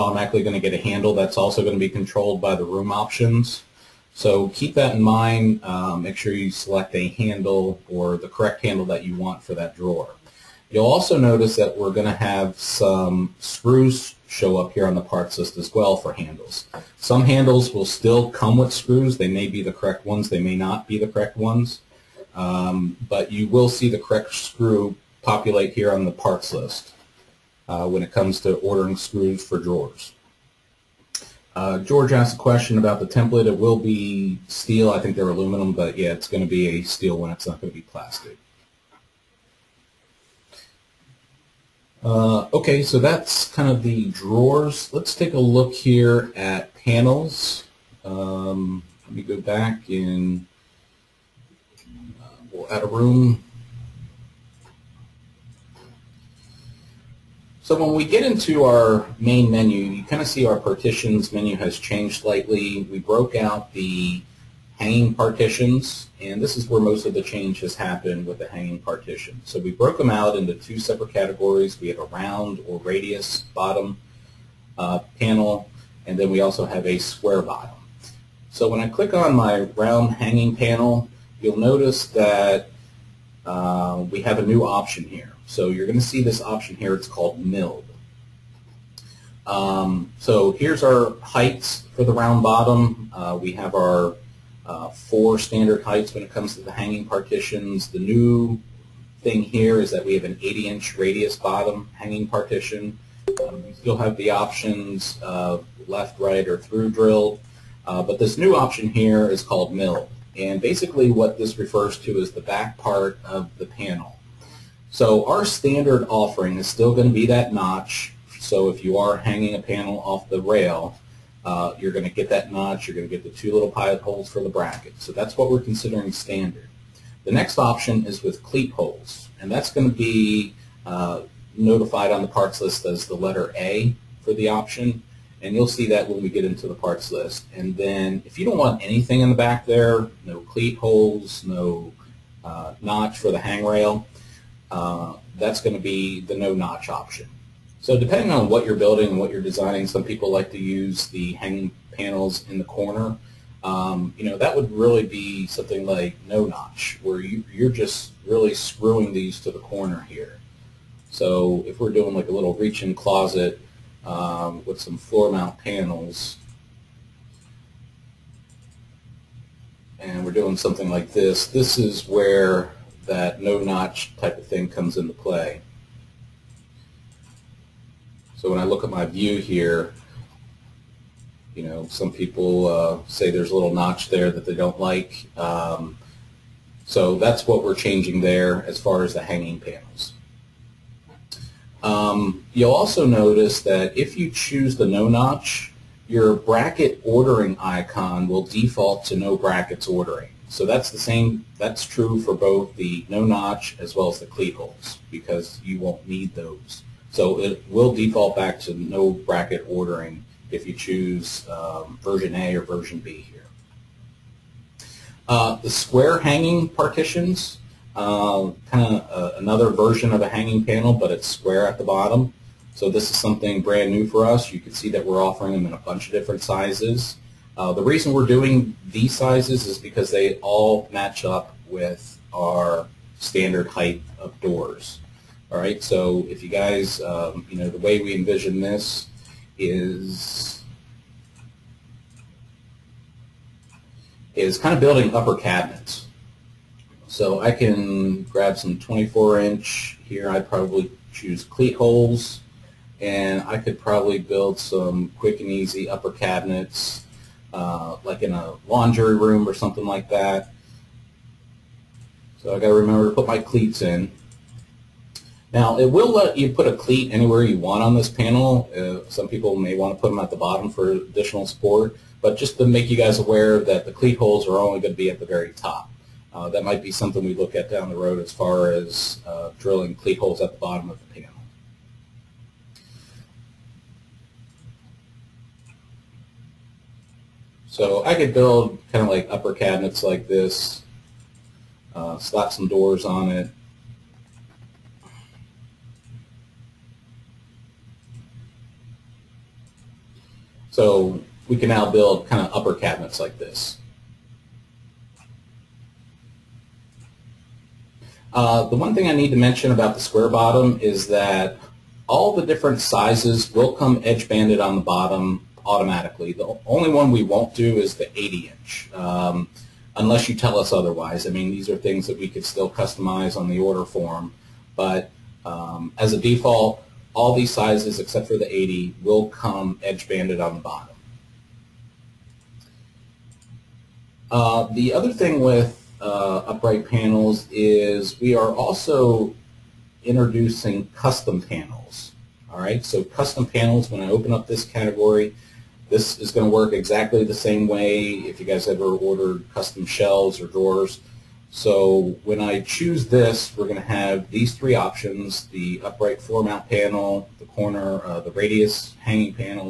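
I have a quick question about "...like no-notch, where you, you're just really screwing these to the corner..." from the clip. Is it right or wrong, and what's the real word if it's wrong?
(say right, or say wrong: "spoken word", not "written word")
right.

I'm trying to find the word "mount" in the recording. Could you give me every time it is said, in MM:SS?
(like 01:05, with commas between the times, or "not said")
02:45, 05:56.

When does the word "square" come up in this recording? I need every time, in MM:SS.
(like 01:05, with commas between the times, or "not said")
01:16, 03:35, 03:41, 05:09.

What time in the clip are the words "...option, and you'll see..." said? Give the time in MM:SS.
02:14.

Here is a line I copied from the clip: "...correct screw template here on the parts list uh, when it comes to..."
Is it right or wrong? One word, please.
wrong.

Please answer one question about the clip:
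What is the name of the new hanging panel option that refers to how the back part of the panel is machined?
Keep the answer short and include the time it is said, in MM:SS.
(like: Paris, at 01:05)
Milled, at 01:26.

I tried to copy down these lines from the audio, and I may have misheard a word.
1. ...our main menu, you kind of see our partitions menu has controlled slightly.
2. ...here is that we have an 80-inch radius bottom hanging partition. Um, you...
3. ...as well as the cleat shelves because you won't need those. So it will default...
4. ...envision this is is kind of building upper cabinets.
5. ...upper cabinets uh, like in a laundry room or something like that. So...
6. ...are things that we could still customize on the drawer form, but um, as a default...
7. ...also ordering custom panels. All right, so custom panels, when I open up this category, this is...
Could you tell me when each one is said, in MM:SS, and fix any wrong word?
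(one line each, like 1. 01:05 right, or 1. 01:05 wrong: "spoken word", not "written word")
1. 00:58 wrong: "changed", not "controlled"
2. 01:39 right
3. 03:23 wrong: "holes", not "shelves"
4. 03:58 right
5. 04:15 right
6. 05:21 wrong: "order", not "drawer"
7. 05:38 wrong: "introducing", not "ordering".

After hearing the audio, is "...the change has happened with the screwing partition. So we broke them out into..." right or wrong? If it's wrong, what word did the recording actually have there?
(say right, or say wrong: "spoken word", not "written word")
wrong: "hanging", not "screwing".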